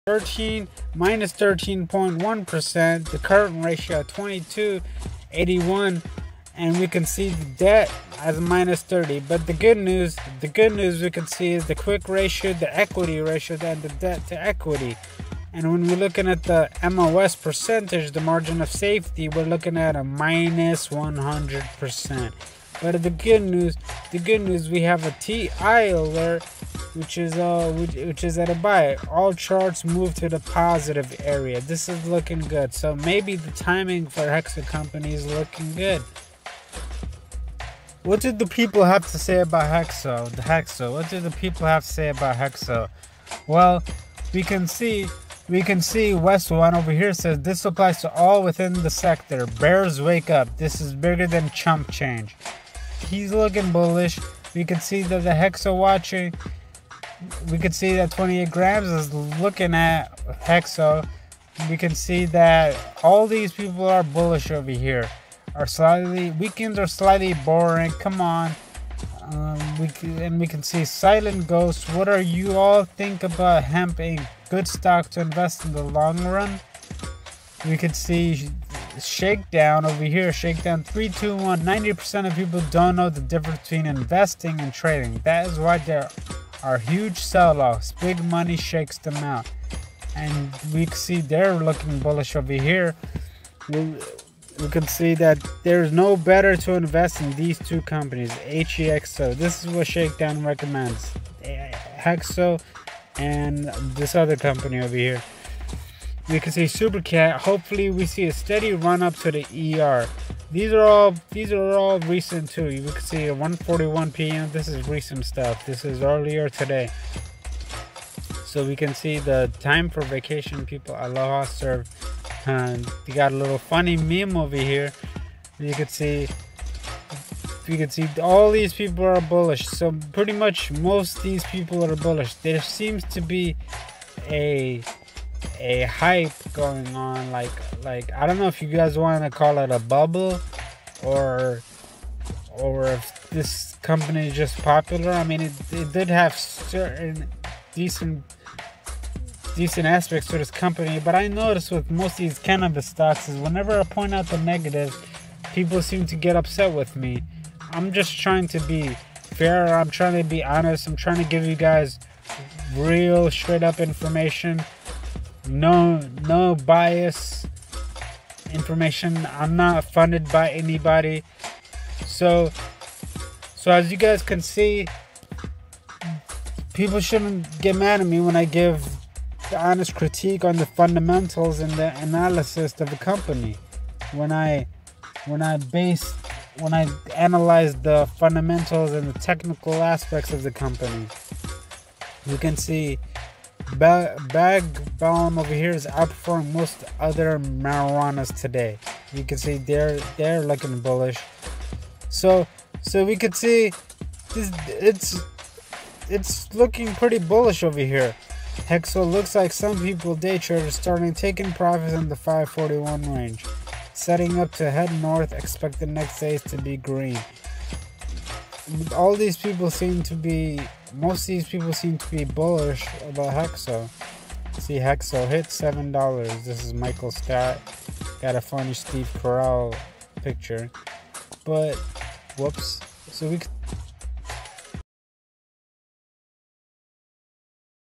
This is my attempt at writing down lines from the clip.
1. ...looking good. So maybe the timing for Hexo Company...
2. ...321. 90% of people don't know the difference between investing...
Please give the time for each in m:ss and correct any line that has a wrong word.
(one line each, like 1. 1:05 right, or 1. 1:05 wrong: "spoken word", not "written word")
1. 0:32 right
2. 1:20 right.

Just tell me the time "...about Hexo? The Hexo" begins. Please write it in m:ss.
0:39.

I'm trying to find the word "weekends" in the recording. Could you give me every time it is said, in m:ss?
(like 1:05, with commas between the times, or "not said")
1:06.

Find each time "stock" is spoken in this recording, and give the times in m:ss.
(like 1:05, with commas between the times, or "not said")
1:14, 2:32.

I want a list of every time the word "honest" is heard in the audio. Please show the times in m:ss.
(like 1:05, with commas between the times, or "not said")
2:40, 2:59.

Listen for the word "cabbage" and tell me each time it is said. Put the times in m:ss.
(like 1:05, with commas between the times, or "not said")
not said.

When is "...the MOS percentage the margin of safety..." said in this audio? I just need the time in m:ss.
0:16.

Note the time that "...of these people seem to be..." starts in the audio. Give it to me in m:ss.
3:41.